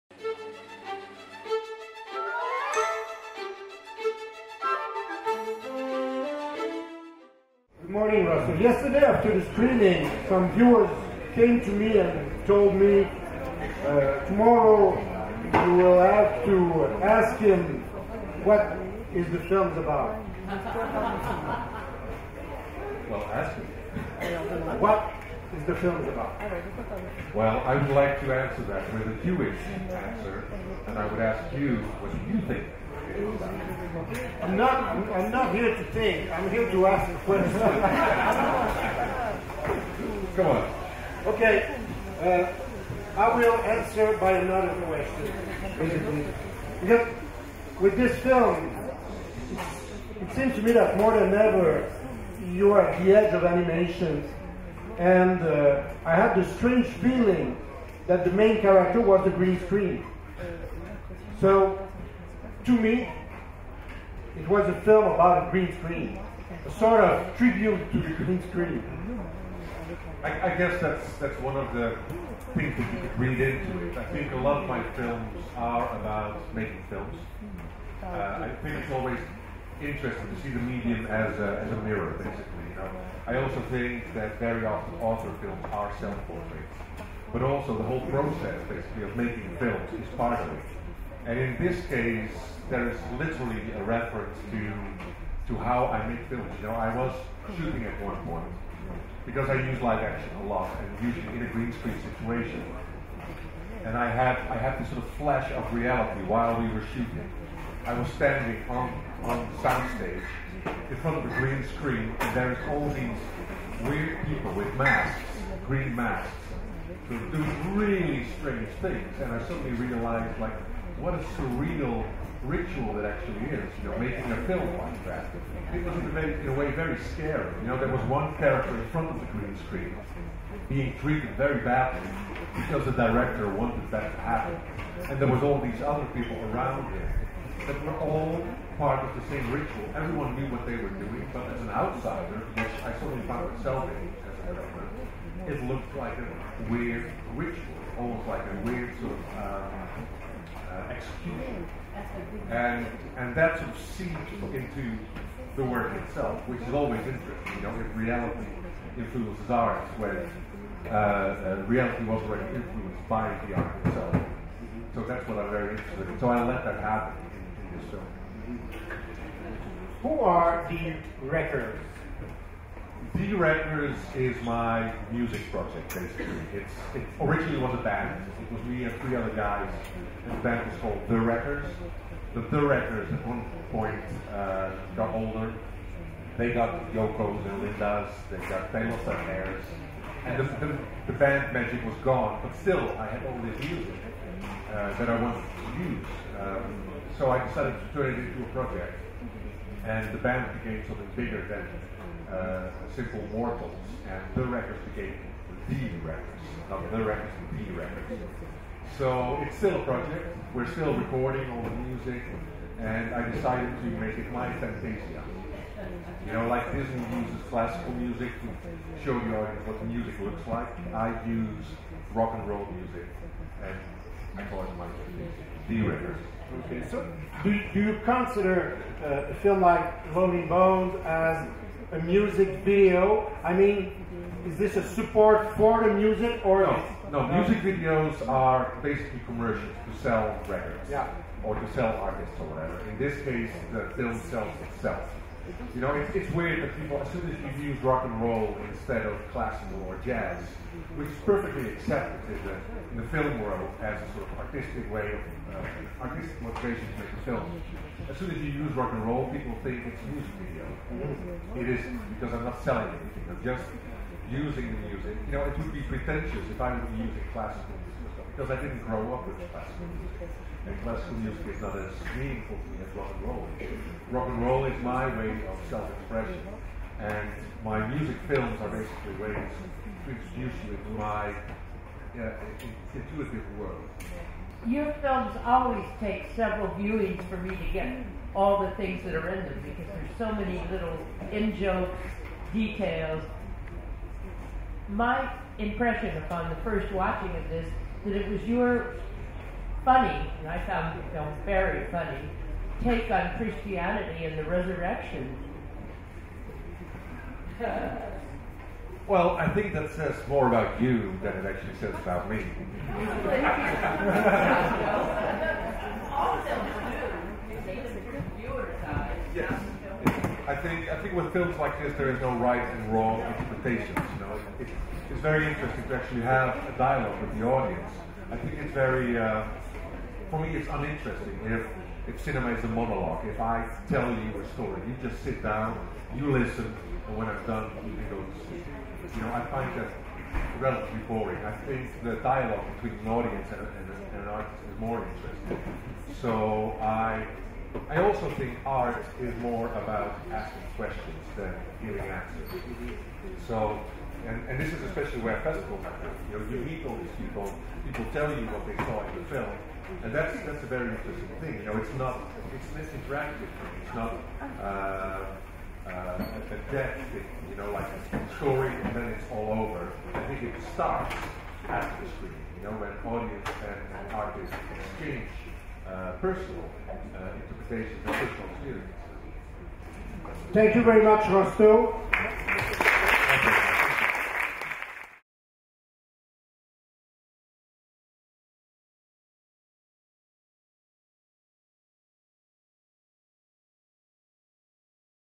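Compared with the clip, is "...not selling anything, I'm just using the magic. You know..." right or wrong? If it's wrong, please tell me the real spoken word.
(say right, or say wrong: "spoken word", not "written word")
wrong: "music", not "magic".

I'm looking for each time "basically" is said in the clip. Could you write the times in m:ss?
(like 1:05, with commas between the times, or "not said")
1:22, 1:28, 2:55, 3:58, 4:38.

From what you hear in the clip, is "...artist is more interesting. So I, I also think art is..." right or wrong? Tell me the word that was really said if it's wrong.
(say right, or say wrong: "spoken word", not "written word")
right.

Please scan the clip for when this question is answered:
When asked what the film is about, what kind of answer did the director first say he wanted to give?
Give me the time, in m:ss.
0:29.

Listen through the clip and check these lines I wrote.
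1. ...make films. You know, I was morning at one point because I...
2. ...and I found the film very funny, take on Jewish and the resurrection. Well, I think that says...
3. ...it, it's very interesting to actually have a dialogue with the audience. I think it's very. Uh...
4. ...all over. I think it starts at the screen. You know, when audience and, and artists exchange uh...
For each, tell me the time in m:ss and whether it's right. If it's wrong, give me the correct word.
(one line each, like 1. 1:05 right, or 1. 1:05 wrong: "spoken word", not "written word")
1. 1:36 wrong: "shooting", not "morning"
2. 5:00 wrong: "Christianity", not "Jewish"
3. 5:24 right
4. 6:09 right.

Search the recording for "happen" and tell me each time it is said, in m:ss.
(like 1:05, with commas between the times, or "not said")
2:14, 2:46, 5:55.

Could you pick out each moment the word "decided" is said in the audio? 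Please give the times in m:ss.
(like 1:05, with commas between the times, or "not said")
3:17, 3:33.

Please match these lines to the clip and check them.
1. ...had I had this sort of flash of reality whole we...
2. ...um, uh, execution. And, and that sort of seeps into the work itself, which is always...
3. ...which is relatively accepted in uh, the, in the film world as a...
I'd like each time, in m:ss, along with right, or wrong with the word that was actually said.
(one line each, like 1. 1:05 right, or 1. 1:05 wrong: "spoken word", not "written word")
1. 1:44 wrong: "while", not "whole"
2. 2:29 right
3. 4:10 wrong: "perfectly", not "relatively".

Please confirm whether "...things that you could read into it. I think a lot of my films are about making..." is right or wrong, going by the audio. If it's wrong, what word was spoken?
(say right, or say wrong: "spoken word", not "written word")
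right.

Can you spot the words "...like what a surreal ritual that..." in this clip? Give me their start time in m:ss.
2:00.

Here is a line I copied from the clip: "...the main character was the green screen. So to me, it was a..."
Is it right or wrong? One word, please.
right.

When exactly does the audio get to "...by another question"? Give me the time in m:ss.
0:44.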